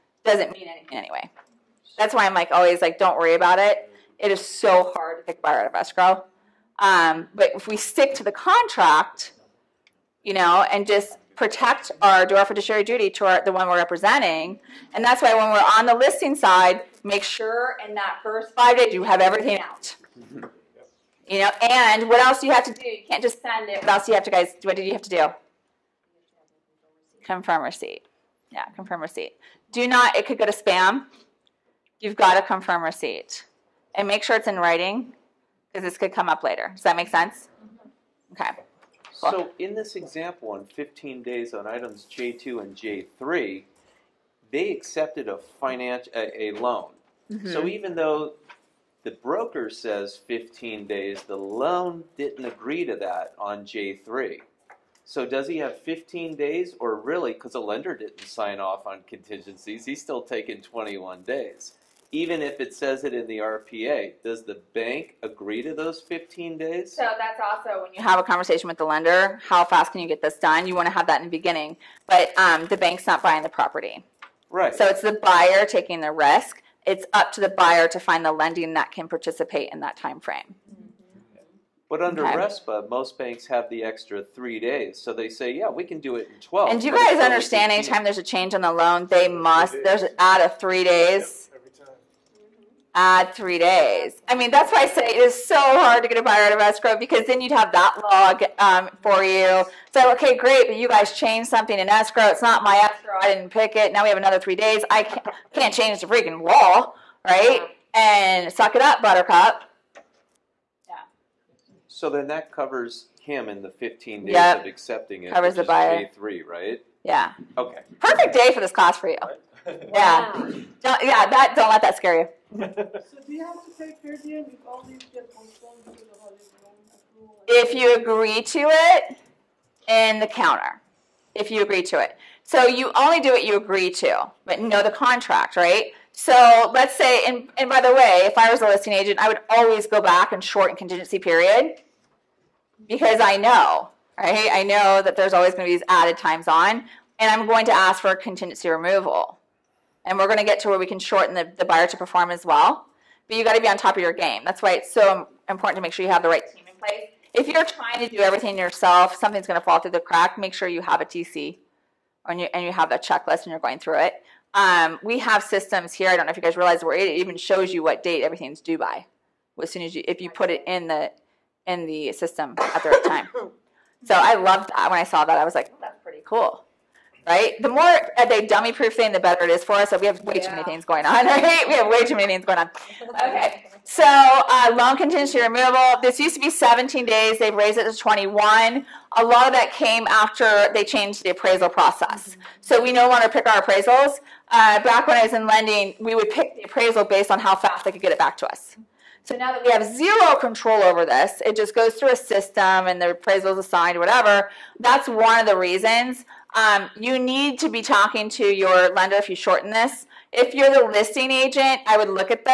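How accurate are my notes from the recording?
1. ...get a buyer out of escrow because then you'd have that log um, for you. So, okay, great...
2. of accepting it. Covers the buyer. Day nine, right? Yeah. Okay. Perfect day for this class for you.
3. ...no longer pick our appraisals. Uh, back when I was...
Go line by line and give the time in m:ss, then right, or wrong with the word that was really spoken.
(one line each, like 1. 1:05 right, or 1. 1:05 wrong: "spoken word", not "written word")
1. 1:36 right
2. 1:54 wrong: "three", not "nine"
3. 3:12 right.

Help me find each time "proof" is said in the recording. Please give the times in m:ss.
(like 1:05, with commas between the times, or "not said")
2:58.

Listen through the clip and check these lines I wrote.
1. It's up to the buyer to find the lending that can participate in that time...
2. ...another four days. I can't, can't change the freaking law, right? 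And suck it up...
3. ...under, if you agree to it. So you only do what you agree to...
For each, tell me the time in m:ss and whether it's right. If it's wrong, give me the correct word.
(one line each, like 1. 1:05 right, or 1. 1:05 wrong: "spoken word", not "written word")
1. 1:16 right
2. 1:44 wrong: "three", not "four"
3. 2:10 wrong: "counter", not "under".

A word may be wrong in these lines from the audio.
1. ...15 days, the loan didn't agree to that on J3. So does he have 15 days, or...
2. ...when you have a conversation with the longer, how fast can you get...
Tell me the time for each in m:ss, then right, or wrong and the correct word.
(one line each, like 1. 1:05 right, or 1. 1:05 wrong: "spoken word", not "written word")
1. 0:50 right
2. 1:07 wrong: "lender", not "longer".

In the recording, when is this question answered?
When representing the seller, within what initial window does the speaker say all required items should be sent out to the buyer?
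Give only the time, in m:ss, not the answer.
0:18.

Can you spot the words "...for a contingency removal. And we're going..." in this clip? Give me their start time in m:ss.
2:27.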